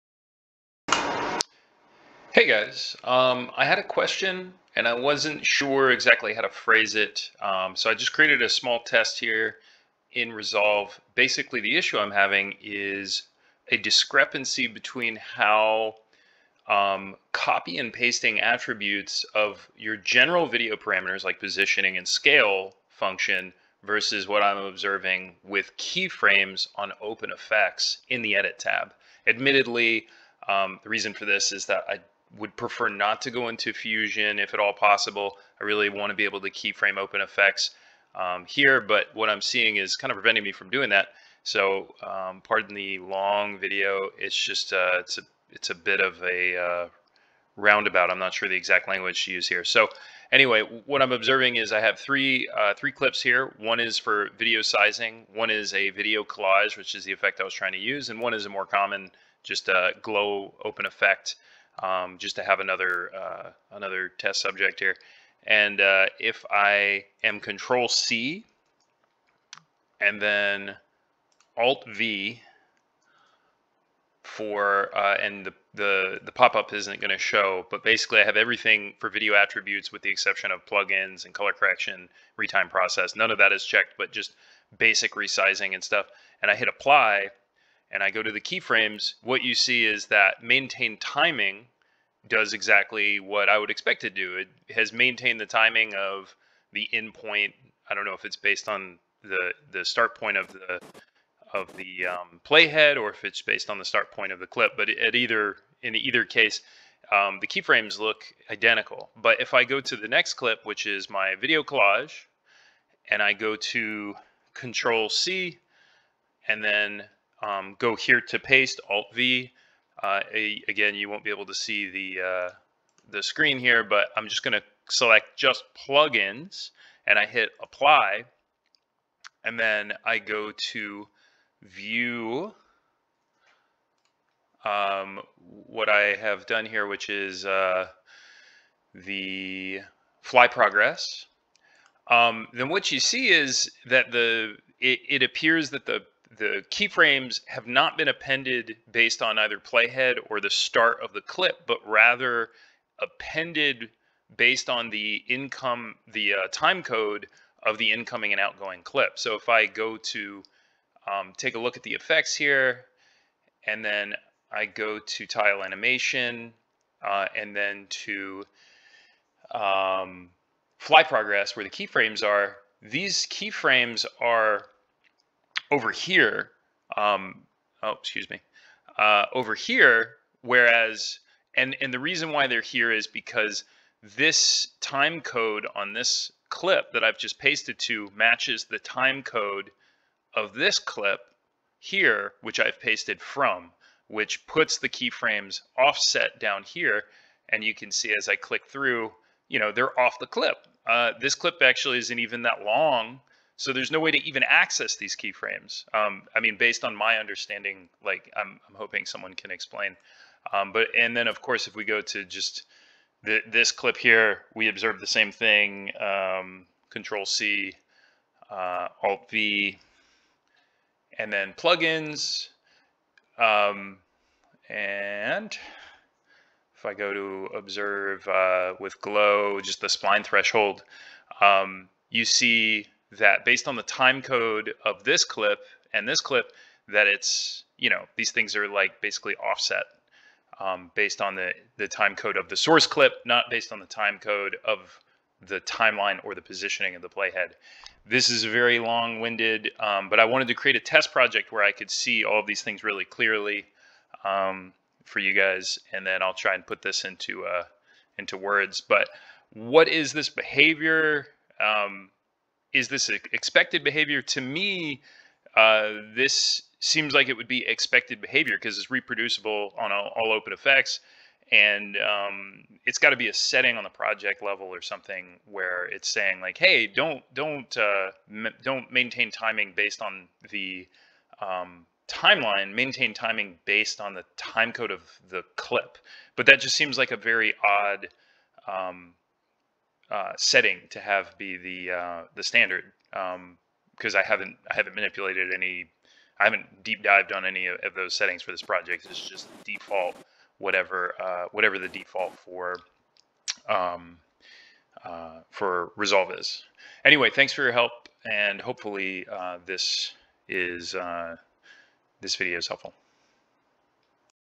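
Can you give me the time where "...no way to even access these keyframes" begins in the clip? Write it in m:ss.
3:23.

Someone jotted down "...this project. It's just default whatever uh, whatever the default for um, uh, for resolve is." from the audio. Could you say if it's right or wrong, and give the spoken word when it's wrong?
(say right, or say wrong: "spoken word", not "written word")
right.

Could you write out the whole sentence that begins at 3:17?
And you can see as I click through, you know, they're off the clip.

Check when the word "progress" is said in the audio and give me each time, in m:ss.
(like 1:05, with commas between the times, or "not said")
2:20, 2:51.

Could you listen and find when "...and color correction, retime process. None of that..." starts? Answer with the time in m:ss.
1:21.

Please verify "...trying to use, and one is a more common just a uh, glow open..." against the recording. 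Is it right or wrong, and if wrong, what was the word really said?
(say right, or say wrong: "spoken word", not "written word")
right.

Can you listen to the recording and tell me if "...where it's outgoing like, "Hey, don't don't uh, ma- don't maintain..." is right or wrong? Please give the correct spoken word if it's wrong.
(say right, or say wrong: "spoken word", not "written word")
wrong: "saying", not "outgoing".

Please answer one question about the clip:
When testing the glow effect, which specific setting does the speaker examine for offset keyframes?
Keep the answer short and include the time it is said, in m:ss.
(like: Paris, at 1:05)
shine threshold, at 3:49.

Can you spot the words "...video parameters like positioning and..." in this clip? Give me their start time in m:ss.
0:20.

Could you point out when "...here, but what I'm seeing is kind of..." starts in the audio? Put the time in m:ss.
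0:38.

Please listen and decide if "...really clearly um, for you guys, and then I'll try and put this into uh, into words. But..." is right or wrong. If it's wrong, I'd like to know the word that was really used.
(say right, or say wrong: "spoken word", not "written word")
right.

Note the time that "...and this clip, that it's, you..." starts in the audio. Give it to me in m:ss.
3:55.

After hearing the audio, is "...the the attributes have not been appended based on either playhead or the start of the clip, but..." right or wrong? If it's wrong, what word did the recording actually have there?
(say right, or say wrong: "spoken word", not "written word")
wrong: "keyframes", not "attributes".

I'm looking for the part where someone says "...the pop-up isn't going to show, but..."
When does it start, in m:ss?
1:16.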